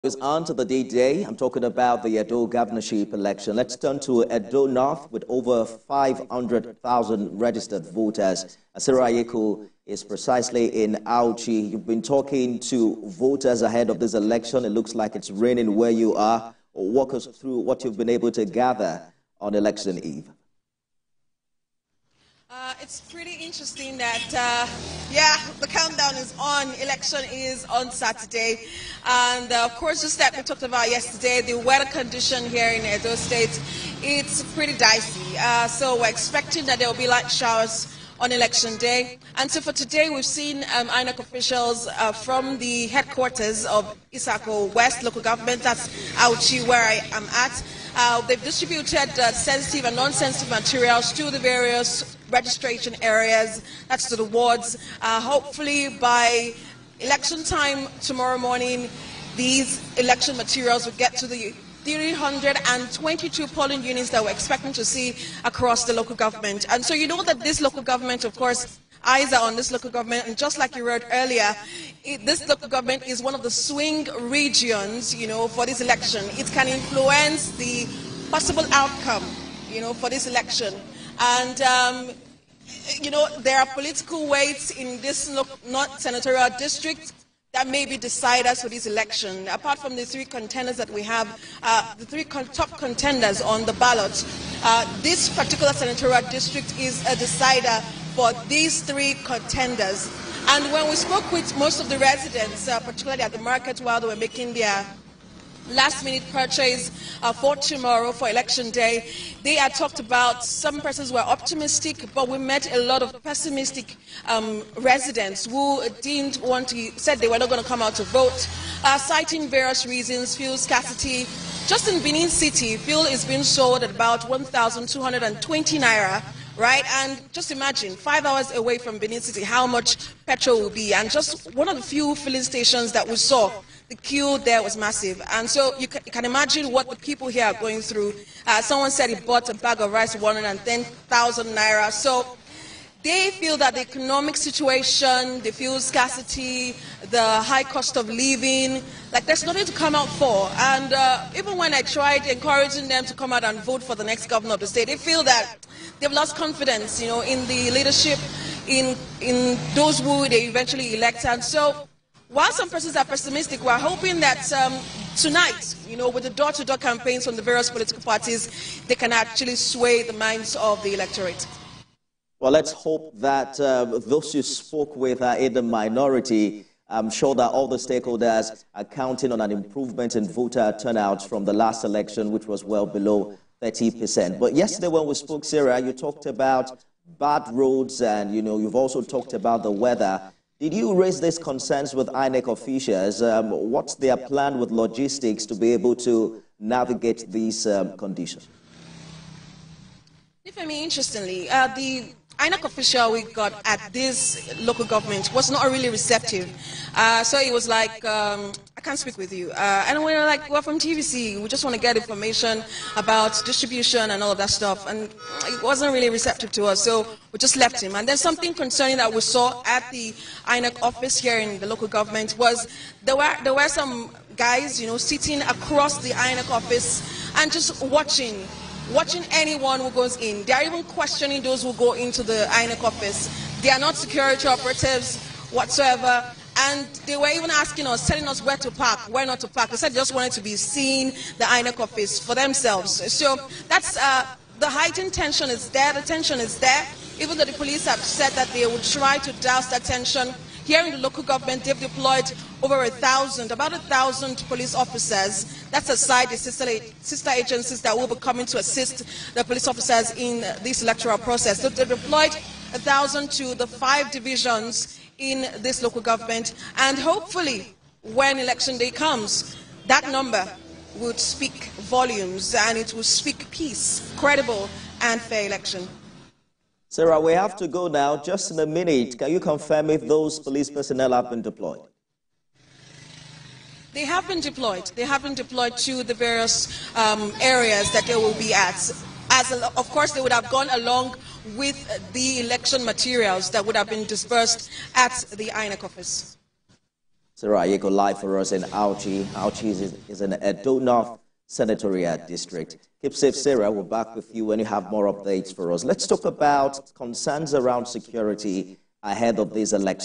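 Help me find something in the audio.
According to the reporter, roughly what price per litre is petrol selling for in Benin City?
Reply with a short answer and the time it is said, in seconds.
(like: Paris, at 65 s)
1,220 naira, at 124 s.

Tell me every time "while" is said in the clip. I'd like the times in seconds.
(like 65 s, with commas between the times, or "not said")
103 s, 162 s.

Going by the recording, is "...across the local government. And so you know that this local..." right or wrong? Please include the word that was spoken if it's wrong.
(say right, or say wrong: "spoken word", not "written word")
right.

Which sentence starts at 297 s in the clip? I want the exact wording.
Sarah you go live for us in Auchi.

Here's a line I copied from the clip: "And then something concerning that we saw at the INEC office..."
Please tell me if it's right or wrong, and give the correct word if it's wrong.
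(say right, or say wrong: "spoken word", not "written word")
right.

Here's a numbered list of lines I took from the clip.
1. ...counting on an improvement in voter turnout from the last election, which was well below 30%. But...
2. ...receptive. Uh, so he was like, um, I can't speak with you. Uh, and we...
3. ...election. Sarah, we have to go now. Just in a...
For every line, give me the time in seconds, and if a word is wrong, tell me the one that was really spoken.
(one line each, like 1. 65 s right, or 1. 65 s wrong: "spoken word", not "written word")
1. 178 s right
2. 205 s right
3. 275 s right.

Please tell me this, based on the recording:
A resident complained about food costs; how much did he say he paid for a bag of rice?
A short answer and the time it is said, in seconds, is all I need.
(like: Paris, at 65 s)
110,000 naira, at 140 s.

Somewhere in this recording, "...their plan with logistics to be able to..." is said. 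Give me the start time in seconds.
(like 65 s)
193 s.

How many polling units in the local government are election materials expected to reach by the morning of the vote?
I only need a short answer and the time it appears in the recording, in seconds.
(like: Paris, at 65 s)
322, at 61 s.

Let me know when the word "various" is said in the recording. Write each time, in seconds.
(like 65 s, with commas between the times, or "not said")
51 s, 119 s, 167 s, 286 s.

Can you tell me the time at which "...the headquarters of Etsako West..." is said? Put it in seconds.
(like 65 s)
42 s.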